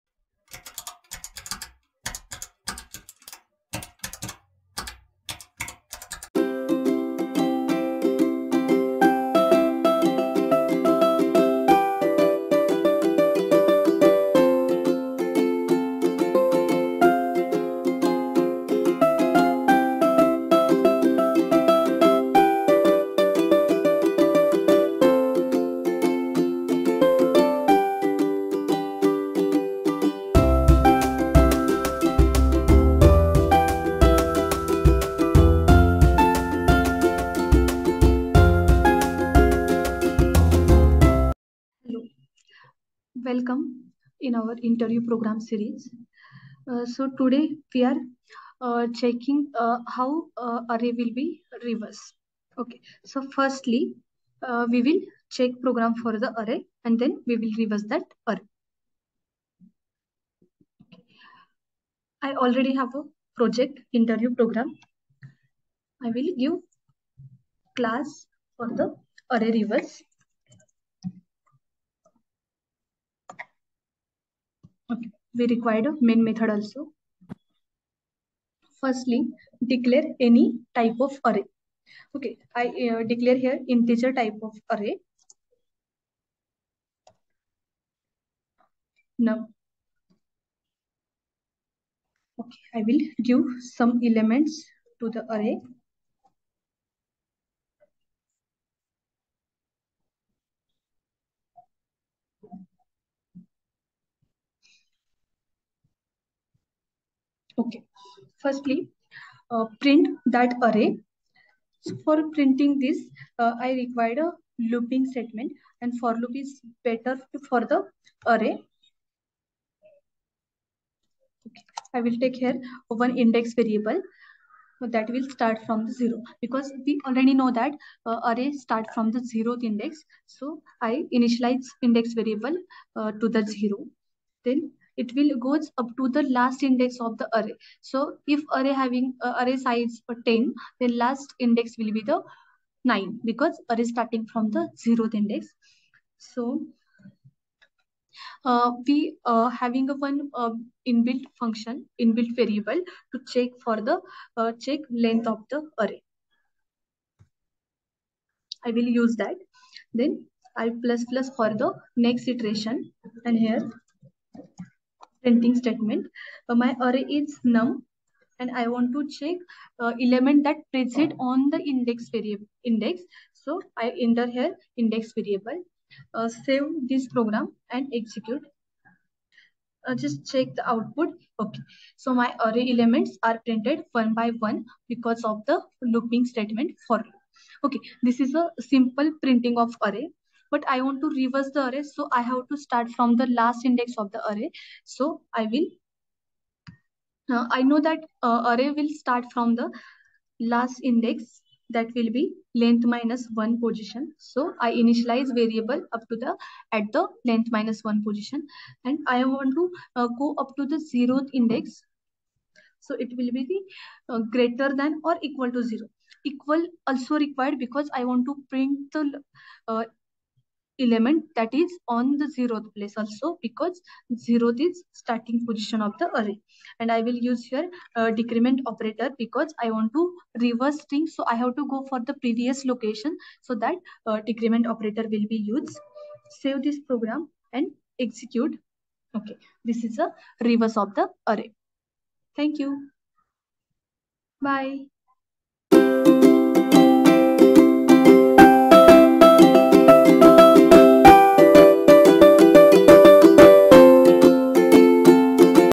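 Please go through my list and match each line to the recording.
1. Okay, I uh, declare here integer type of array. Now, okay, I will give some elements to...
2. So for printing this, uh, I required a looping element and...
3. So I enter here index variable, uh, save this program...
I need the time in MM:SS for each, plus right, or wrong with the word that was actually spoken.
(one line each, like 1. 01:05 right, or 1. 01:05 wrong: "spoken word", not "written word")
1. 01:22 right
2. 01:51 wrong: "statement", not "element"
3. 02:53 right.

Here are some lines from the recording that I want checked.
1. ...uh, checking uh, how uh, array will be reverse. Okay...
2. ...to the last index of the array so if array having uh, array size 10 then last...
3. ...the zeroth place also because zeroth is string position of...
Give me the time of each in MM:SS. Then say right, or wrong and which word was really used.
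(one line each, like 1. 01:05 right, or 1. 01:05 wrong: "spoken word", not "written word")
1. 00:48 right
2. 02:15 right
3. 03:42 wrong: "starting", not "string".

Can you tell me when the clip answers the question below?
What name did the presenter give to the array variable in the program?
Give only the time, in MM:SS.
02:47.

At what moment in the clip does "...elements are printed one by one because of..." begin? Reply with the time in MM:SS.
03:02.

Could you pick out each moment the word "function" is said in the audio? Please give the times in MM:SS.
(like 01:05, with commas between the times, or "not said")
02:31.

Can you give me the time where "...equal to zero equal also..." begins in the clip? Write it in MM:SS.
03:35.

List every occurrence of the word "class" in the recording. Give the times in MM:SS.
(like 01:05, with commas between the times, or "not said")
01:07.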